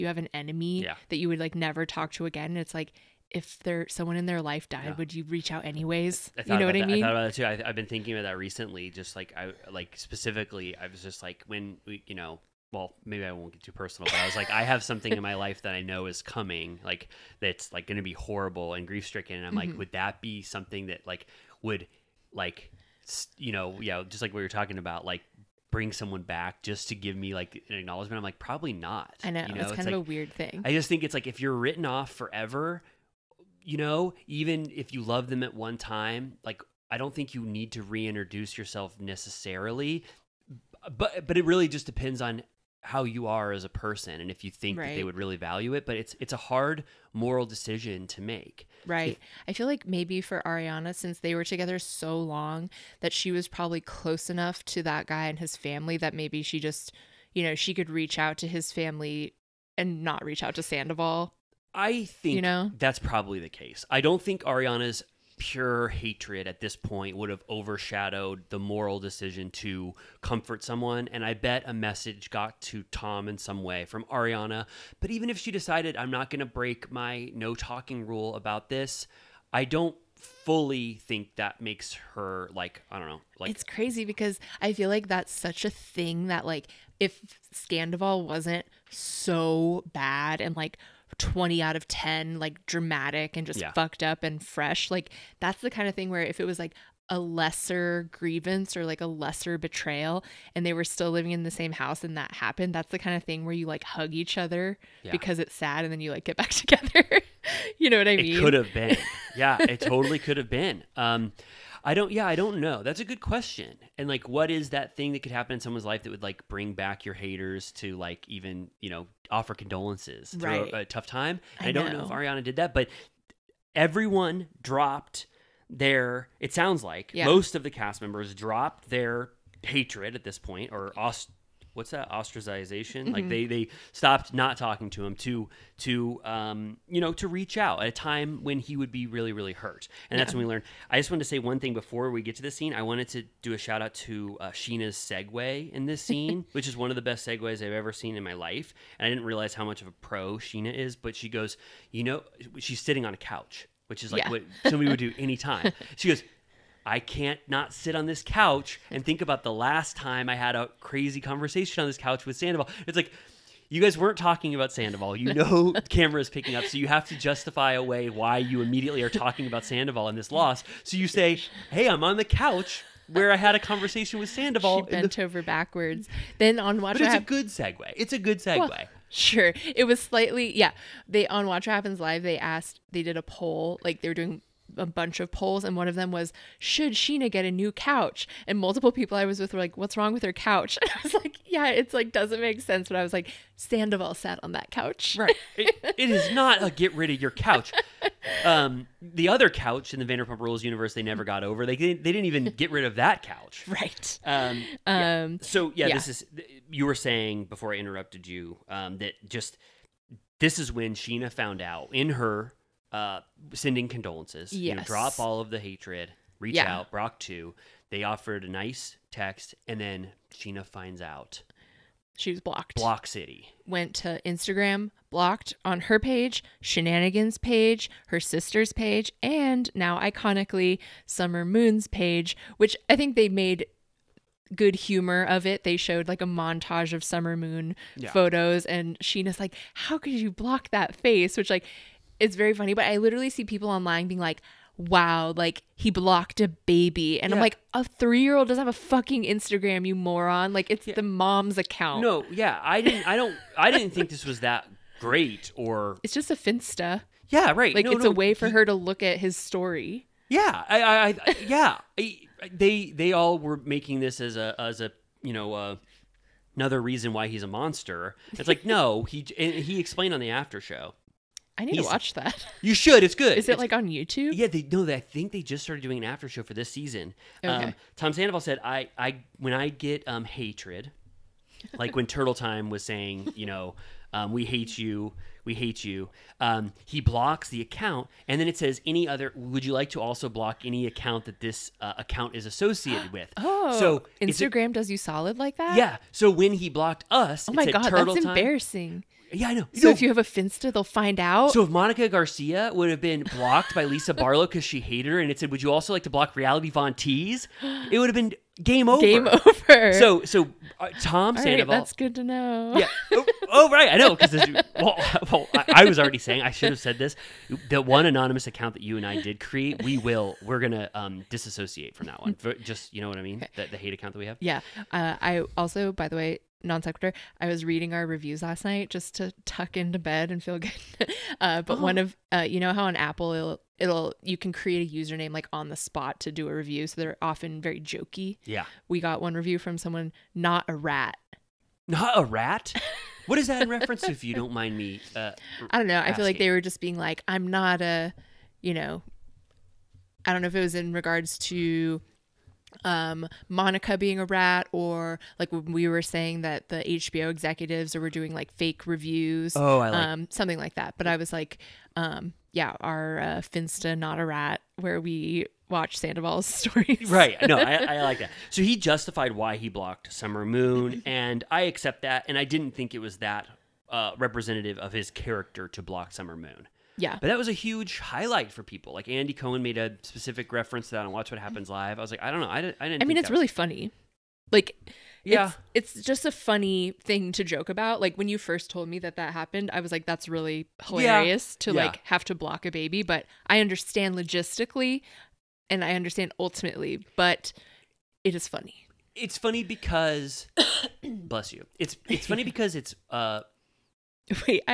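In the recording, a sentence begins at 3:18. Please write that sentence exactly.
Um, the other couch in the Vanderpump Rules universe, they never got over.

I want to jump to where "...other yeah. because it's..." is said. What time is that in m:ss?
1:44.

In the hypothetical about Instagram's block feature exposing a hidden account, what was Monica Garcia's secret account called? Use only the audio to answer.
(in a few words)
Reality Von Tease.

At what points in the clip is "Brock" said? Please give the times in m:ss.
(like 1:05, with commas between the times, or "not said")
3:36.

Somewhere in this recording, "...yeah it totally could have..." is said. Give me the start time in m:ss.
1:49.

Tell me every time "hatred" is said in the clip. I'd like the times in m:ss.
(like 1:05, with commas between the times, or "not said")
1:05, 2:09, 3:35, 4:40.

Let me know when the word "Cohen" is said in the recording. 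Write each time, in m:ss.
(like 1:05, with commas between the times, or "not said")
6:19.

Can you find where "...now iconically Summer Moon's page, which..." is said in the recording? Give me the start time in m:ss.
3:49.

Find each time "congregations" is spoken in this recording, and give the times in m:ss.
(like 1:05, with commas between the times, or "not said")
not said.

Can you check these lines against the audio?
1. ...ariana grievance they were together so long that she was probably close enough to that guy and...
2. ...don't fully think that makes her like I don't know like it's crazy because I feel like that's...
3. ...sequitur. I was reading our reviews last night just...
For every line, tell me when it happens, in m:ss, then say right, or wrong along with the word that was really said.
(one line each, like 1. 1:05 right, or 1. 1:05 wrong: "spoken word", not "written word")
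1. 0:50 wrong: "since", not "grievance"
2. 1:19 right
3. 5:26 right.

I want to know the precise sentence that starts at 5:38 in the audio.
Yeah, we got one review from someone not a rat.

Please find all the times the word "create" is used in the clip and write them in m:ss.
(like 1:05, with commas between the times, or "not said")
5:19, 5:34.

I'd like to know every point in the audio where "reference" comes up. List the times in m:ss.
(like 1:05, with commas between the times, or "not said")
5:43, 6:20.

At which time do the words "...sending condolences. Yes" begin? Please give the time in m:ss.
3:33.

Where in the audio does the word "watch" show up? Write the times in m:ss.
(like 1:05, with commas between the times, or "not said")
2:56, 3:01, 4:31, 6:05, 6:21.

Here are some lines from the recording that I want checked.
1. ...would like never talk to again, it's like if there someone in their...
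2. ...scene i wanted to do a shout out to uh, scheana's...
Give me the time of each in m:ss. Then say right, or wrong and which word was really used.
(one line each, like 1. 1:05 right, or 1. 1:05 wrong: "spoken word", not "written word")
1. 0:01 right
2. 2:22 right.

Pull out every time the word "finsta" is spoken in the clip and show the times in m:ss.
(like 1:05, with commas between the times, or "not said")
4:16, 5:00, 6:03.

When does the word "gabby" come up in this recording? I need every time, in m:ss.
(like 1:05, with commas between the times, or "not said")
not said.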